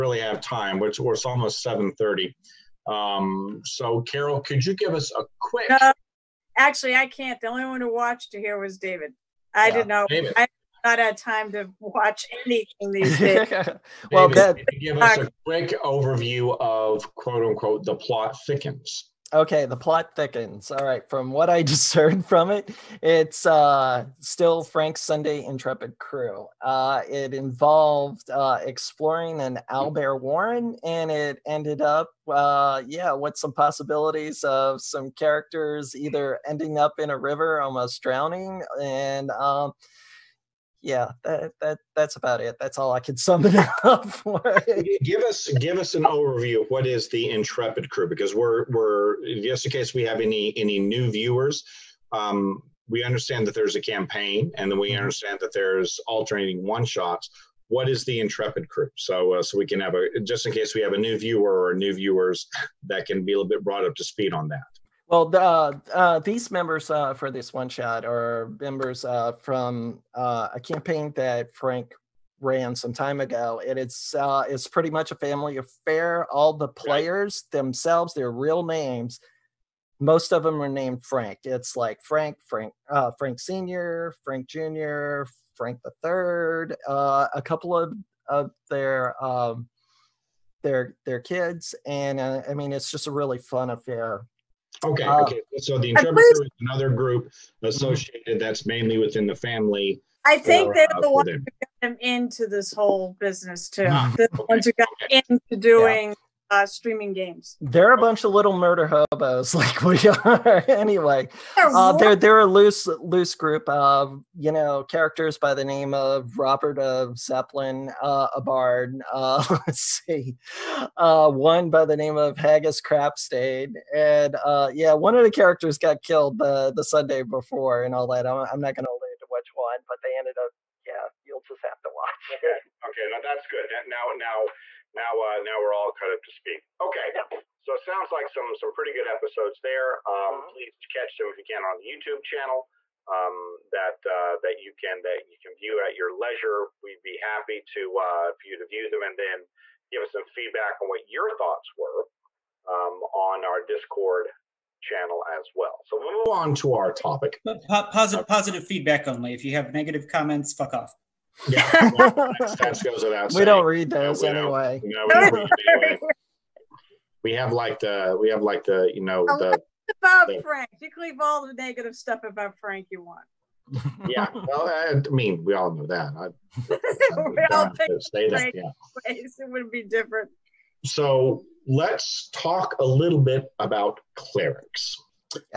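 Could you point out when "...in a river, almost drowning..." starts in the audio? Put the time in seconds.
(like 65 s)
36 s.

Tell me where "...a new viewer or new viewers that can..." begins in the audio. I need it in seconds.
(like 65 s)
60 s.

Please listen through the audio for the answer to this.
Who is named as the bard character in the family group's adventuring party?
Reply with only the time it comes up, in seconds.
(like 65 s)
116 s.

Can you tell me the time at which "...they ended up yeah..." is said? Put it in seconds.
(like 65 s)
130 s.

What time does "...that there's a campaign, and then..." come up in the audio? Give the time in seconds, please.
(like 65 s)
53 s.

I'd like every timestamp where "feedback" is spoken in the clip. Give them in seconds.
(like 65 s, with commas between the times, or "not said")
150 s, 158 s.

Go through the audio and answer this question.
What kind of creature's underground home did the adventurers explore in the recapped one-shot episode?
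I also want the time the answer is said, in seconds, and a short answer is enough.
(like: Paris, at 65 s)
Owlbear, at 29 s.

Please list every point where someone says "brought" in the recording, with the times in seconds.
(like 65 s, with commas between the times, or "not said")
63 s.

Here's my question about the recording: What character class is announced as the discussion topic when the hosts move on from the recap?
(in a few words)
Clerics.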